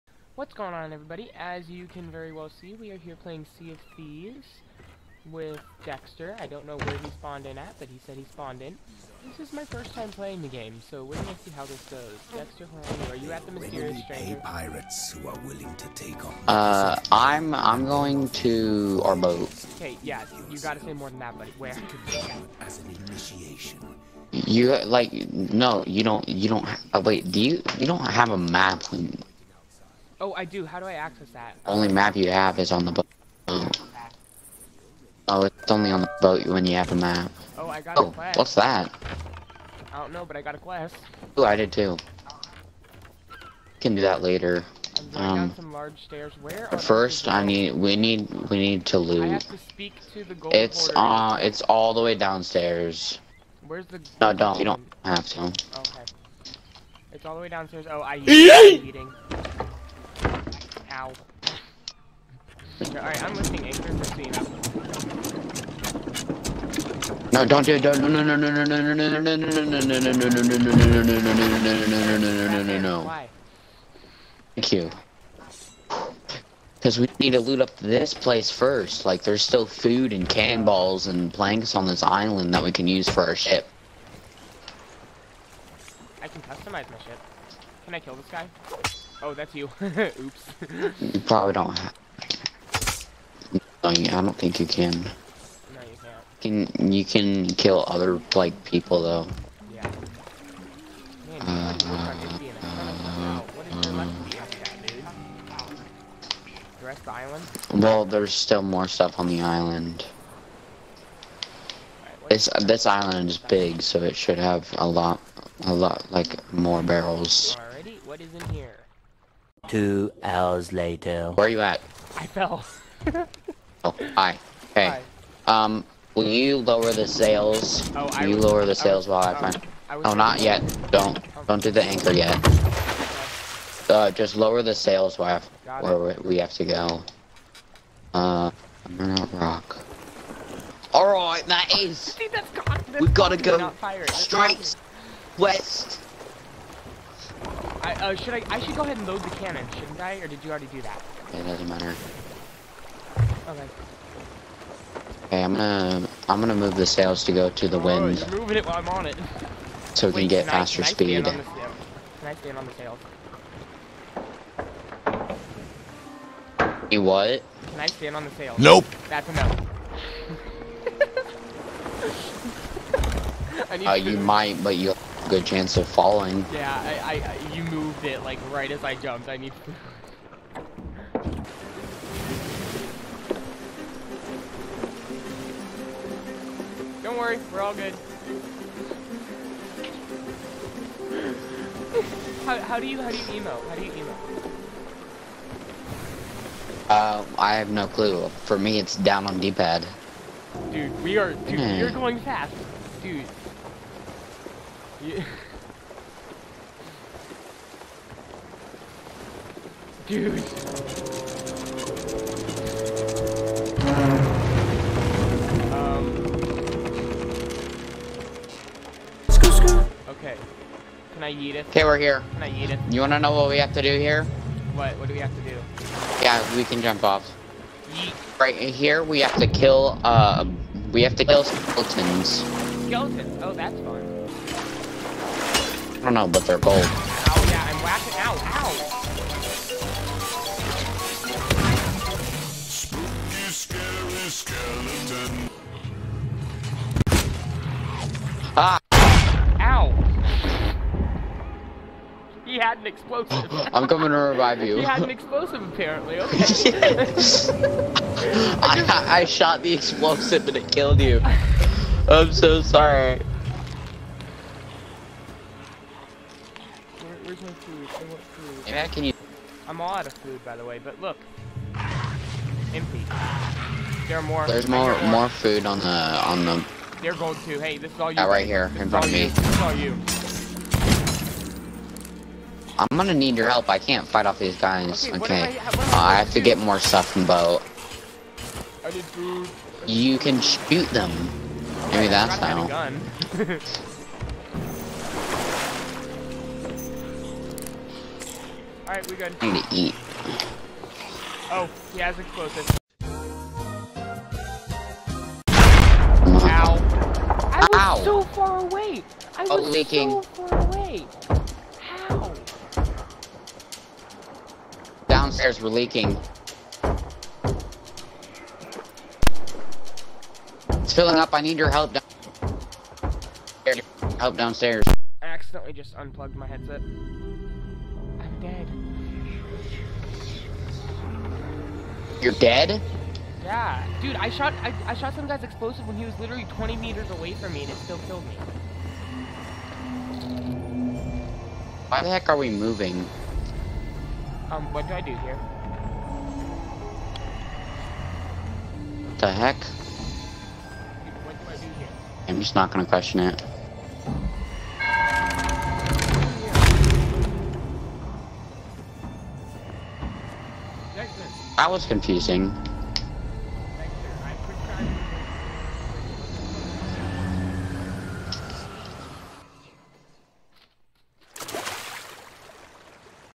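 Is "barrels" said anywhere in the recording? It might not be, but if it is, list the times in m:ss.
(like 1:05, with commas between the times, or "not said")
1:56.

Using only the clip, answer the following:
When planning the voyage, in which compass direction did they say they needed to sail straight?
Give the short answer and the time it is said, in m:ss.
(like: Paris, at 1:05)
West, at 2:24.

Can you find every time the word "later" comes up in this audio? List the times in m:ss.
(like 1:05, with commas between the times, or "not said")
0:44, 2:00.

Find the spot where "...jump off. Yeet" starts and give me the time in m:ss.
3:46.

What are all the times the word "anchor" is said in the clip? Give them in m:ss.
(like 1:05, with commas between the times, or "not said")
2:11.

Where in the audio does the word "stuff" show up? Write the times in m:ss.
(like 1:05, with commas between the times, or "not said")
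1:48, 4:46.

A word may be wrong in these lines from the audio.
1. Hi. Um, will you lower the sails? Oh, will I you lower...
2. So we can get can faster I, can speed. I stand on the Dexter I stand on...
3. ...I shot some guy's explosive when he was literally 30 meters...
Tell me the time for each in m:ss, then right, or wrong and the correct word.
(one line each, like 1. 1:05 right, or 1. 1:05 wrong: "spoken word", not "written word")
1. 2:05 right
2. 2:39 wrong: "Can", not "Dexter"
3. 5:34 wrong: "20", not "30".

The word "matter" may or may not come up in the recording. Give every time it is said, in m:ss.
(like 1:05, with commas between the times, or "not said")
2:31.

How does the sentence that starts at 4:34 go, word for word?
There's more, more more food on the on the.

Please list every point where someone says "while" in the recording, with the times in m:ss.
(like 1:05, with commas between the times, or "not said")
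2:09, 2:15, 2:38.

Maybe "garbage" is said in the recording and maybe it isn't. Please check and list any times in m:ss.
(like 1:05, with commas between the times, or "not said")
not said.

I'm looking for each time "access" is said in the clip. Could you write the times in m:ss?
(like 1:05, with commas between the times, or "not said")
0:30.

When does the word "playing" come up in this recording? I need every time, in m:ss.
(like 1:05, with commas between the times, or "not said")
0:03, 0:10.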